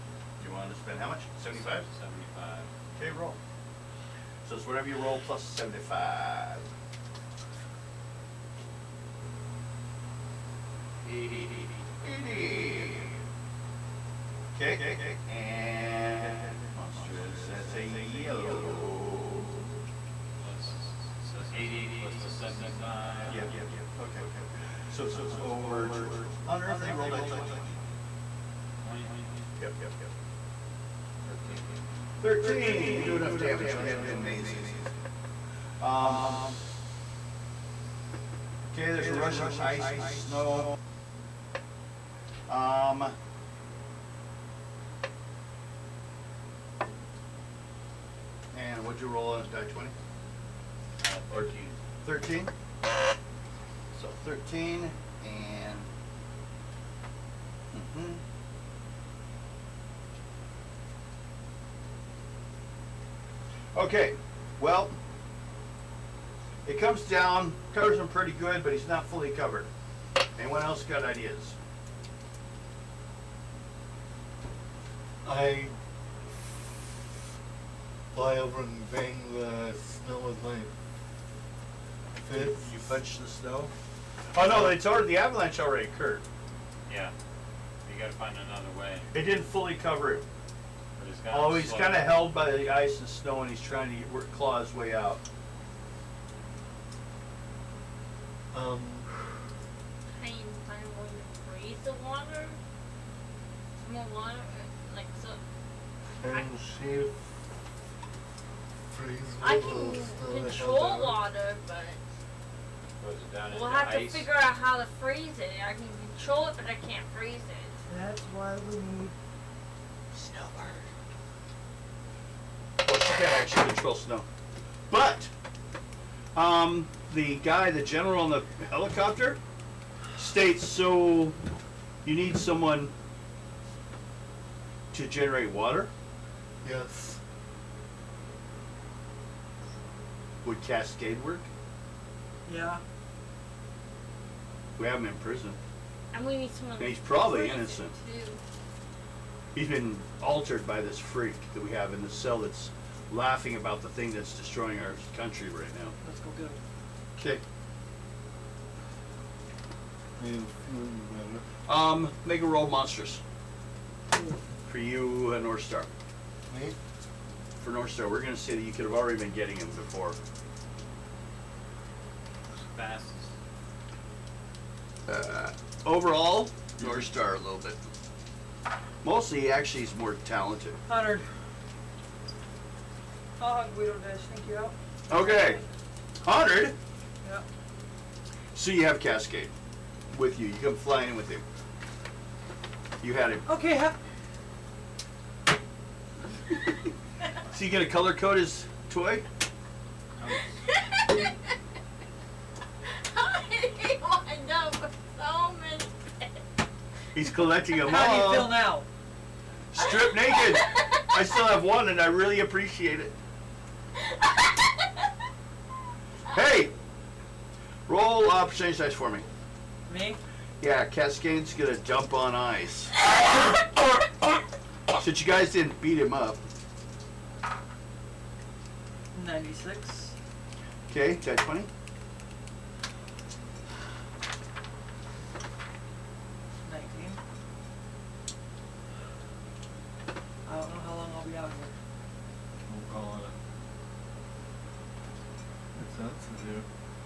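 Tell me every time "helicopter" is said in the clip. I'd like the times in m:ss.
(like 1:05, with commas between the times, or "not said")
2:08.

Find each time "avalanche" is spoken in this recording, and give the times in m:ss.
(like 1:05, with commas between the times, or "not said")
1:25.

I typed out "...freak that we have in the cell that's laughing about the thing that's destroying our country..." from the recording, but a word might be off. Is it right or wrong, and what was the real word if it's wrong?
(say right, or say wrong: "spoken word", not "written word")
right.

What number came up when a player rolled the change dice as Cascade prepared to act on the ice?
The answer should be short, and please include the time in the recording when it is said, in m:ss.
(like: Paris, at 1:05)
96, at 3:49.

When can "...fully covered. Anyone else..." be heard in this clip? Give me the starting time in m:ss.
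1:09.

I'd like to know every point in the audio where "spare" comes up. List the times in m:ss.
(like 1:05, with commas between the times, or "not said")
not said.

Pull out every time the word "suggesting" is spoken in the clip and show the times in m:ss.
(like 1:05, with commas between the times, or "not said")
not said.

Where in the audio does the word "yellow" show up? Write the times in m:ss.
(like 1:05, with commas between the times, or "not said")
0:17.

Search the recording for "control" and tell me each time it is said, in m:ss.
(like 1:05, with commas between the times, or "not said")
1:50, 1:56, 2:03.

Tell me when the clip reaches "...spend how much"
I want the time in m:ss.
0:00.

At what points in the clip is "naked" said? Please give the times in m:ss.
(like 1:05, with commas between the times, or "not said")
3:30.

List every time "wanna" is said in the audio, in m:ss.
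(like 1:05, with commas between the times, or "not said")
0:00.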